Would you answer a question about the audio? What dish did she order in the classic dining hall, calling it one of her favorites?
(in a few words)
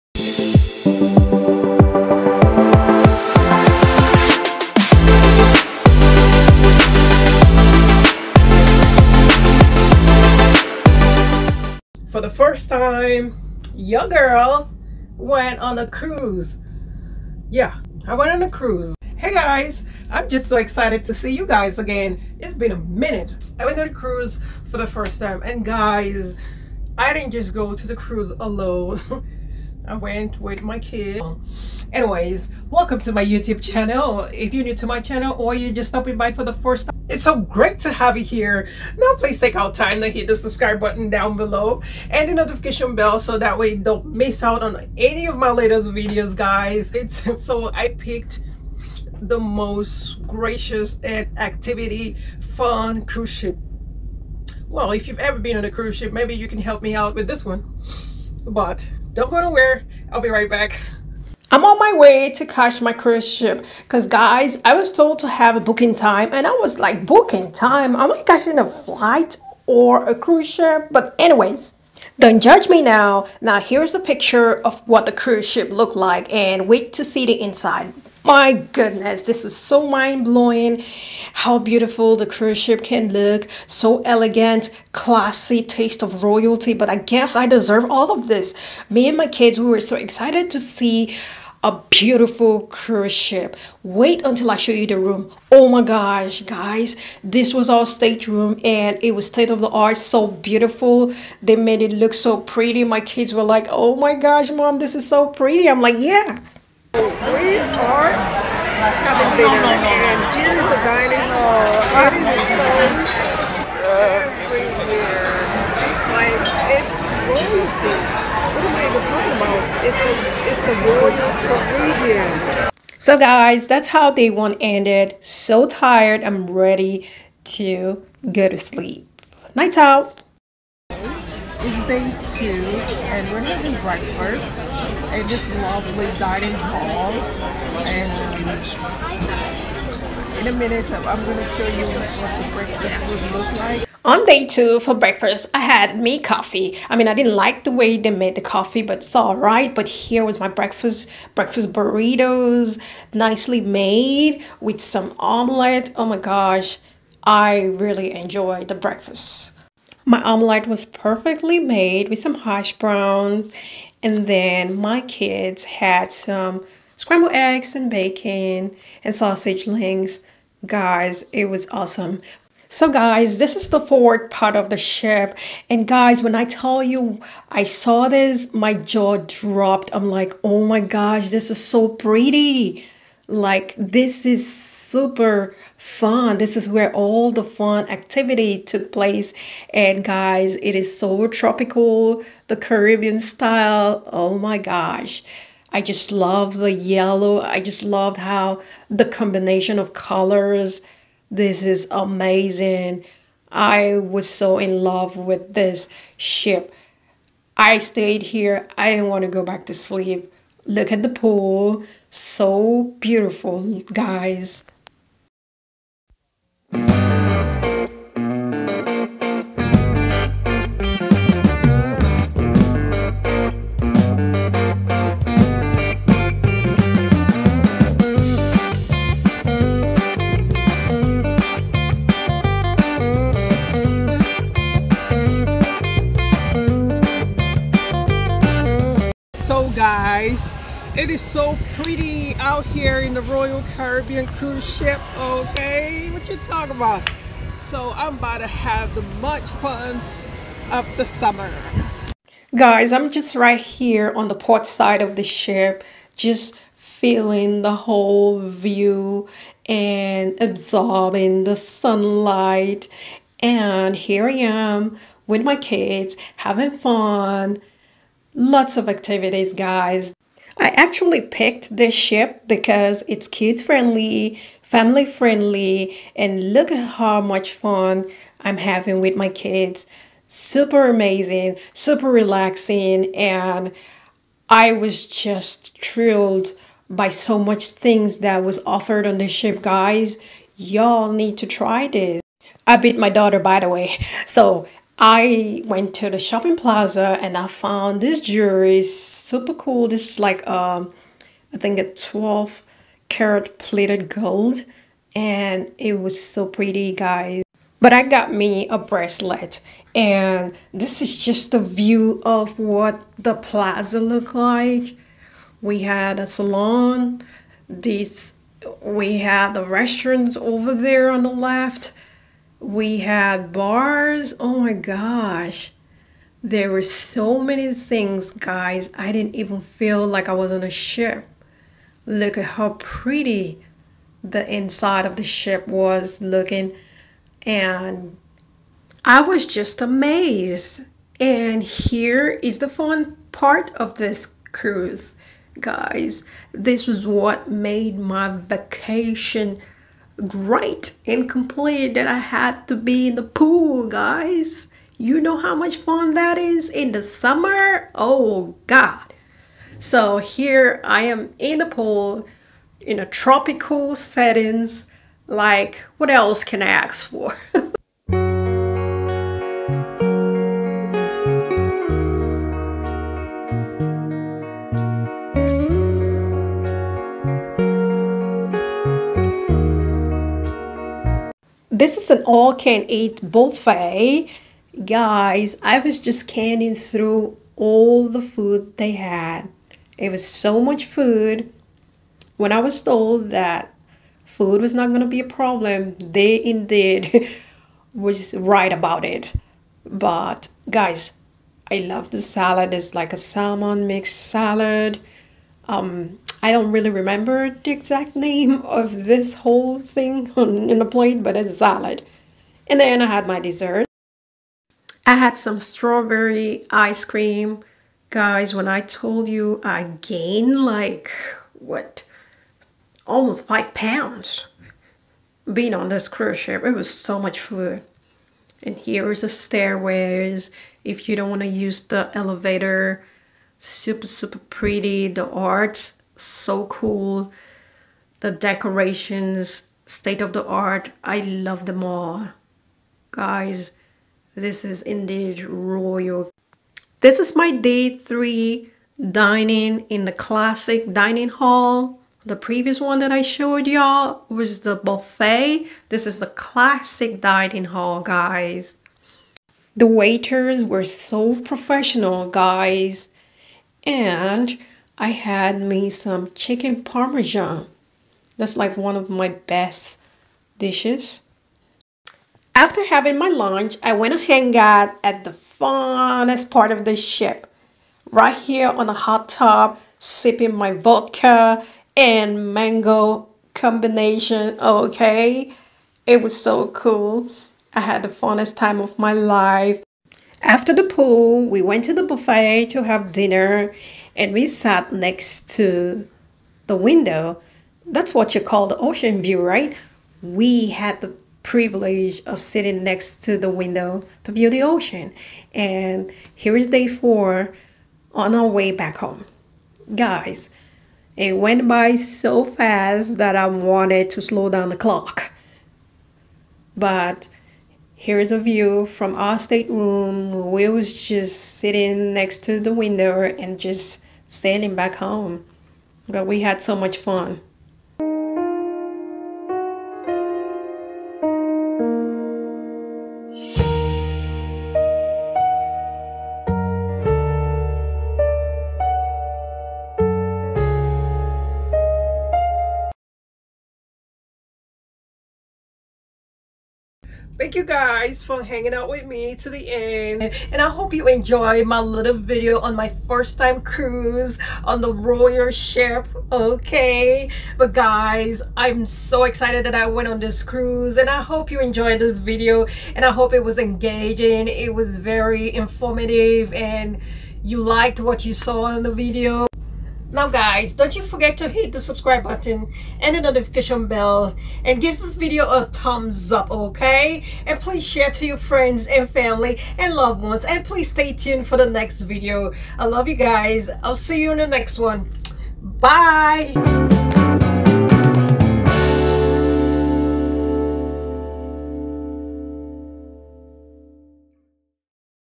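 Chicken parmesan.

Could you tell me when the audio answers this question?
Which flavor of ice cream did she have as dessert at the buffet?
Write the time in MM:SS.
06:55.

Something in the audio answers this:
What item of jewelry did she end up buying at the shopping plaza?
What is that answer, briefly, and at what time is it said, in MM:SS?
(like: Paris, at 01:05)
A bracelet, at 05:08.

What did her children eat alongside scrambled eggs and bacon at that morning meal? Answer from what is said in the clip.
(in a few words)
Sausage links.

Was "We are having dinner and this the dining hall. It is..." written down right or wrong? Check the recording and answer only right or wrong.
right.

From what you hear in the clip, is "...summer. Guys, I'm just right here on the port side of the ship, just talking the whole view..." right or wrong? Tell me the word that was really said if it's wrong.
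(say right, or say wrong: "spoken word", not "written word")
wrong: "feeling", not "talking".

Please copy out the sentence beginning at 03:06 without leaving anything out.
This is where all the fun activity took place.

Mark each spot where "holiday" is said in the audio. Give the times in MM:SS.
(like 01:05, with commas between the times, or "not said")
not said.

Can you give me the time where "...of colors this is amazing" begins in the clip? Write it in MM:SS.
03:19.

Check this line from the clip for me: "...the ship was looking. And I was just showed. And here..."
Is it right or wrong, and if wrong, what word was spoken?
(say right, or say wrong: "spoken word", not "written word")
wrong: "amazed", not "showed".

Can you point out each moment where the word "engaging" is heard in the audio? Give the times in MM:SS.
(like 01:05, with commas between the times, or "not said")
09:23.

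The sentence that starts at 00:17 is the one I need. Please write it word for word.
Yeah, I went on a cruise.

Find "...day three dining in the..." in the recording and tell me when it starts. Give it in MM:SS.
07:27.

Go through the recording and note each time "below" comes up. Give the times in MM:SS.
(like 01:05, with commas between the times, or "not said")
00:41.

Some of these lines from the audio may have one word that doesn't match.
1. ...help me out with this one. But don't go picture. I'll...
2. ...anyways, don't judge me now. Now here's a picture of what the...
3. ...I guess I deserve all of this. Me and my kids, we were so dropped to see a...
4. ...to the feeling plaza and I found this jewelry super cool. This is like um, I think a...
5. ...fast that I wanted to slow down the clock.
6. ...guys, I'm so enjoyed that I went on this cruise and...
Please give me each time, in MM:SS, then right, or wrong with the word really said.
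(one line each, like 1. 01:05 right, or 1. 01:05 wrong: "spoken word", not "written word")
1. 00:56 wrong: "nowhere", not "picture"
2. 01:11 right
3. 01:26 wrong: "excited", not "dropped"
4. 04:55 wrong: "shopping", not "feeling"
5. 08:32 right
6. 09:17 wrong: "excited", not "enjoyed".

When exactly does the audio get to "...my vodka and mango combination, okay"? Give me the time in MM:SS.
08:00.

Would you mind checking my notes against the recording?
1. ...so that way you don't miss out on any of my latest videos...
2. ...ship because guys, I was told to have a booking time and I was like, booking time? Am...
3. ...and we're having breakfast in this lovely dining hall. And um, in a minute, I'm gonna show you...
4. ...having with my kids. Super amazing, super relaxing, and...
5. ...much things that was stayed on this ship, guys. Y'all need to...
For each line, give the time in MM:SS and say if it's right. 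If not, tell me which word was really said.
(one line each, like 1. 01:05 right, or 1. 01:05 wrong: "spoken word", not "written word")
1. 00:43 right
2. 01:03 right
3. 02:13 right
4. 04:38 right
5. 04:47 wrong: "offered", not "stayed".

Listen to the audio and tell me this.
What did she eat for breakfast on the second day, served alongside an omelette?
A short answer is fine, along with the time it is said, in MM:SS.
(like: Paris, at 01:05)
Breakfast burritos, at 02:31.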